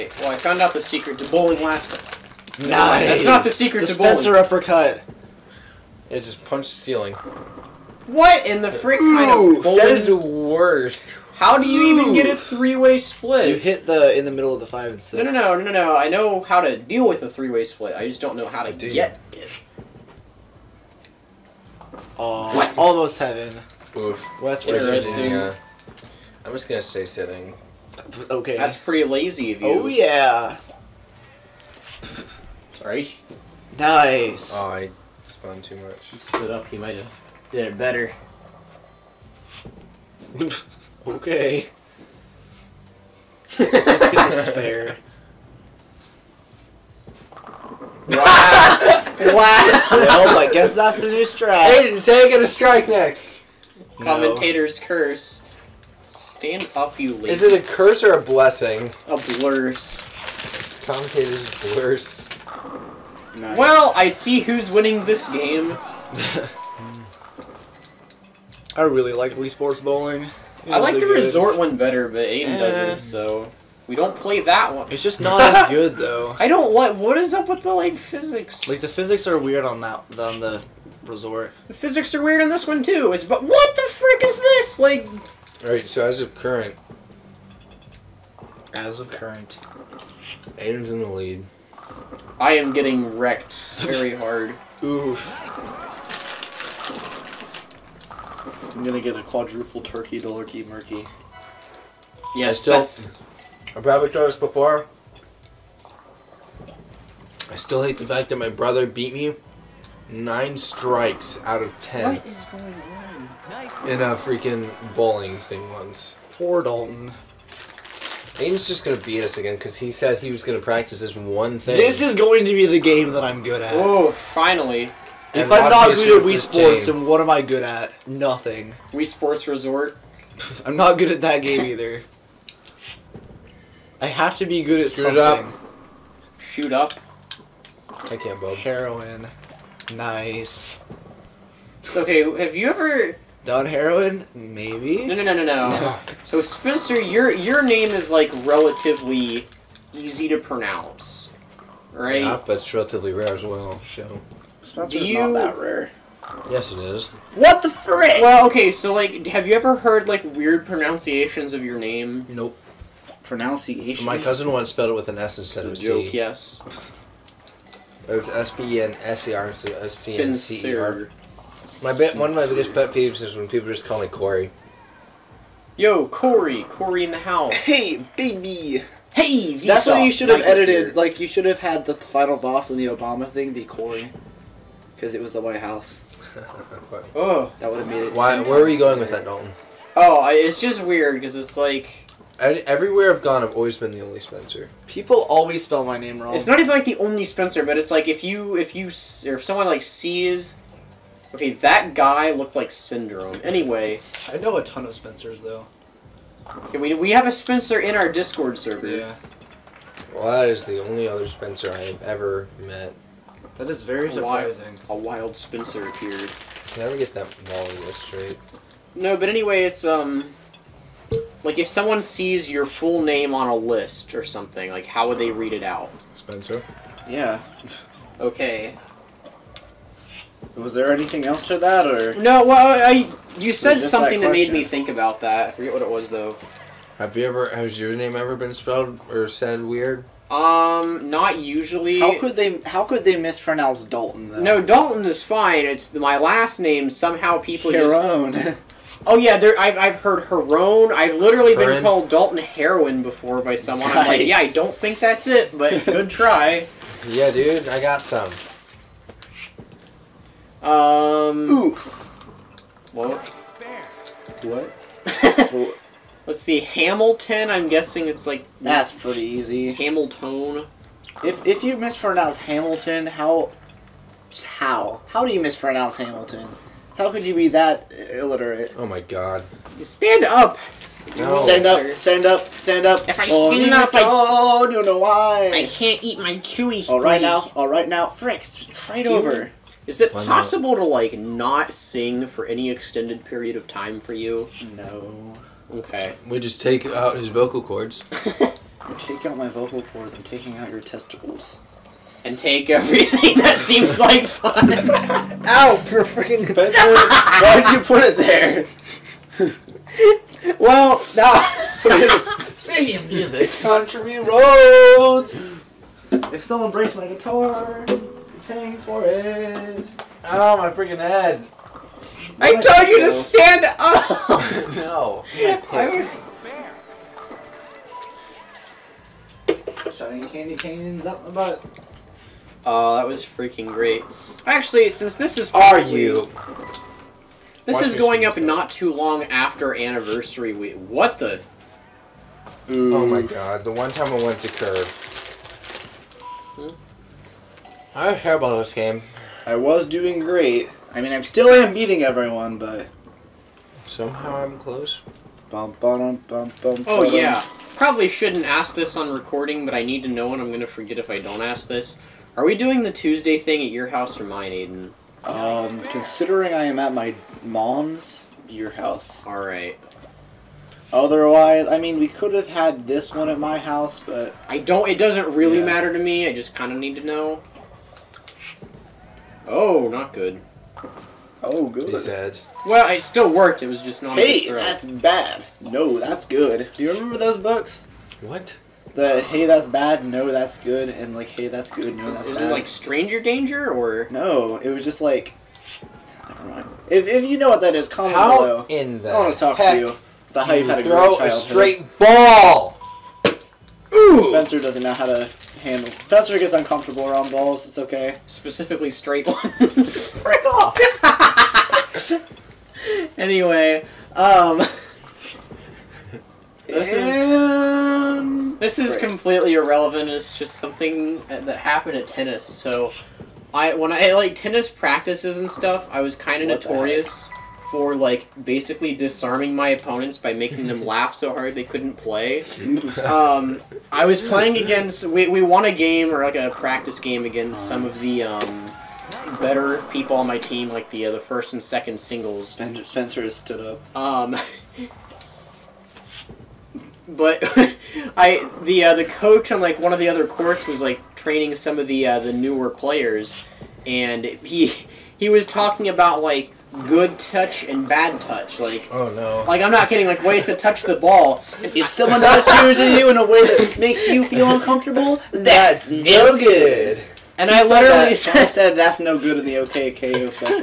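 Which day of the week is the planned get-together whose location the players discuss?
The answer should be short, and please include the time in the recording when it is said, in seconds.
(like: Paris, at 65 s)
Tuesday, at 362 s.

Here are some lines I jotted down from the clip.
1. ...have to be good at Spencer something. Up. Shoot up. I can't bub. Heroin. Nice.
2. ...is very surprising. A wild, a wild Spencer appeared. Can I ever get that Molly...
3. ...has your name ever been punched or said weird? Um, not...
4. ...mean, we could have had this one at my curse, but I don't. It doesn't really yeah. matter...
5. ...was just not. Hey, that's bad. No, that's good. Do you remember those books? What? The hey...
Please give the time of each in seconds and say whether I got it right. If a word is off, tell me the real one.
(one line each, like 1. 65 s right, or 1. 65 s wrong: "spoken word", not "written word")
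1. 134 s wrong: "Shoot", not "Spencer"
2. 213 s right
3. 237 s wrong: "spelled", not "punched"
4. 371 s wrong: "house", not "curse"
5. 383 s right.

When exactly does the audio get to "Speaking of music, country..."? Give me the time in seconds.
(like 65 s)
312 s.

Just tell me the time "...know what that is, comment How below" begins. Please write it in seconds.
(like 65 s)
397 s.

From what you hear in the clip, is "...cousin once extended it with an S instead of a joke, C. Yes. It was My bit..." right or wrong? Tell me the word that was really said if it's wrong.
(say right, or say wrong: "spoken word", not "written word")
wrong: "spelled", not "extended".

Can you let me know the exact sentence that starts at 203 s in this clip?
Anyway, I know a ton of Spencers though.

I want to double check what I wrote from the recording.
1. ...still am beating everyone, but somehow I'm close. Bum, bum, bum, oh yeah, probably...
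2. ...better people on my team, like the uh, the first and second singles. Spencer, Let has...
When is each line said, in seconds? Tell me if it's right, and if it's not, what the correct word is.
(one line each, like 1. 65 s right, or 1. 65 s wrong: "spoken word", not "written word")
1. 351 s right
2. 439 s wrong: "Spencer", not "Let".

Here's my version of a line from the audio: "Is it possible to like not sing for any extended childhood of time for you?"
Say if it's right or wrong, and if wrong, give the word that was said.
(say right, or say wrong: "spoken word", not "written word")
wrong: "period", not "childhood".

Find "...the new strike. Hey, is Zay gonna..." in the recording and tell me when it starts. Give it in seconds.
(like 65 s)
51 s.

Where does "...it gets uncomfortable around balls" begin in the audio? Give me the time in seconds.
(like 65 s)
406 s.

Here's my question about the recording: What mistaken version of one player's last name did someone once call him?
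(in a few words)
Dalton Heroin.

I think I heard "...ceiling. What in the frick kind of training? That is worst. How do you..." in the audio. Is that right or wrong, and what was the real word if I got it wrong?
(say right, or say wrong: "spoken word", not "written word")
wrong: "bowling", not "training".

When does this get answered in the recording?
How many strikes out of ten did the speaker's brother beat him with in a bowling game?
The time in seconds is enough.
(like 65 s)
110 s.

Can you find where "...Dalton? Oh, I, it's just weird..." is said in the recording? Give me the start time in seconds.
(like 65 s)
189 s.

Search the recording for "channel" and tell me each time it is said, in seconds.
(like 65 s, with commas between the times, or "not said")
not said.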